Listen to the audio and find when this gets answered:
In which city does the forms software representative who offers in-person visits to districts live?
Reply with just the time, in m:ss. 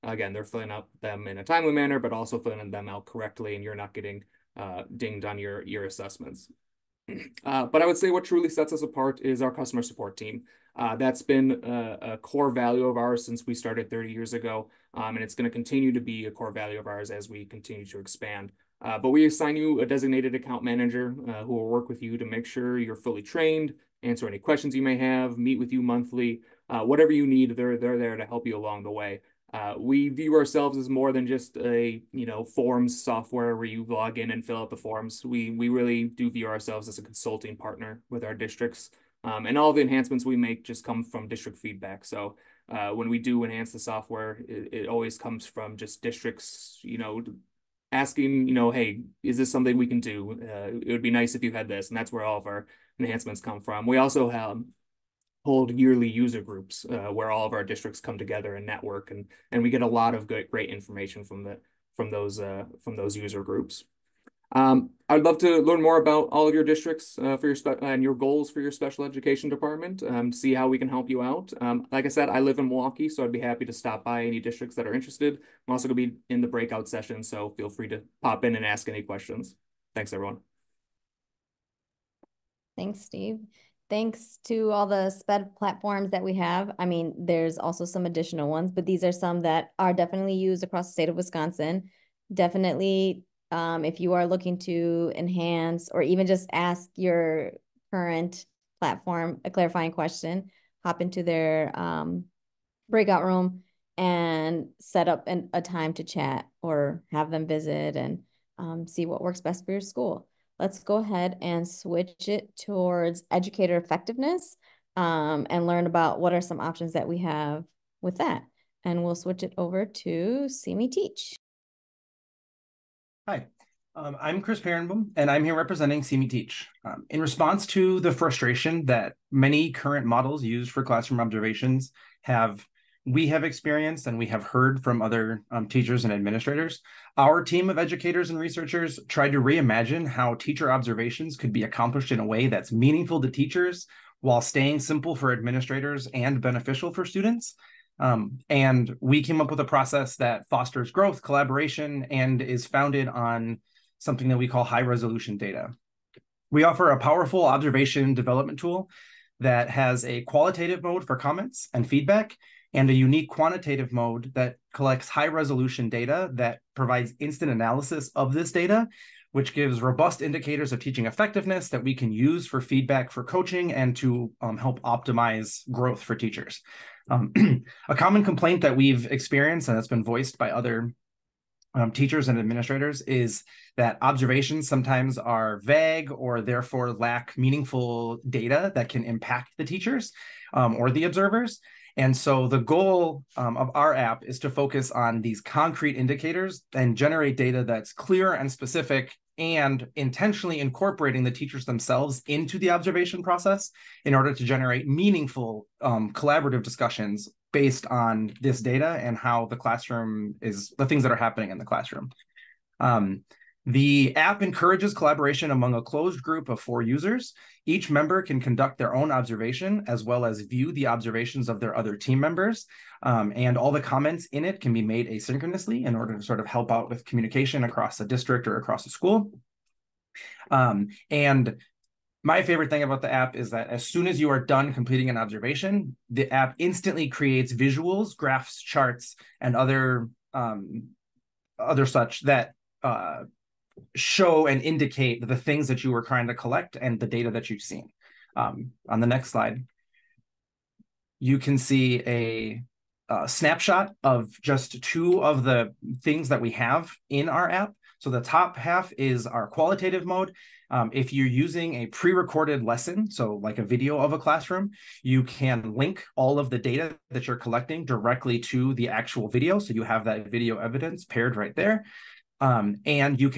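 1:12.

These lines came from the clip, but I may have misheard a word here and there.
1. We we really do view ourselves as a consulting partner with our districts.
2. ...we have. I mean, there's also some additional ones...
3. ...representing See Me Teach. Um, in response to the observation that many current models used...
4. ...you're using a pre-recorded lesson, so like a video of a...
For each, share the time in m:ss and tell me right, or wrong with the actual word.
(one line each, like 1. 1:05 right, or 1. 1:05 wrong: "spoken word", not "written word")
1. 0:35 right
2. 1:26 right
3. 2:05 wrong: "frustration", not "observation"
4. 4:21 right.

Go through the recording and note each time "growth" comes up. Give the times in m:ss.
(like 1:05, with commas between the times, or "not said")
2:30, 2:55.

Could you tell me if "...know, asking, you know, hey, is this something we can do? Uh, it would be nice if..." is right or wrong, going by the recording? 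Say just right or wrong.
right.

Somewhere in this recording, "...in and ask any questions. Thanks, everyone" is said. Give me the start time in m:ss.
1:18.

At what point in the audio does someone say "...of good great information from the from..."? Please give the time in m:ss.
1:00.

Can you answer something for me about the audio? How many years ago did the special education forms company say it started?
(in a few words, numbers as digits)
30.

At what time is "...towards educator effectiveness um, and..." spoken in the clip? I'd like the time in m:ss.
1:52.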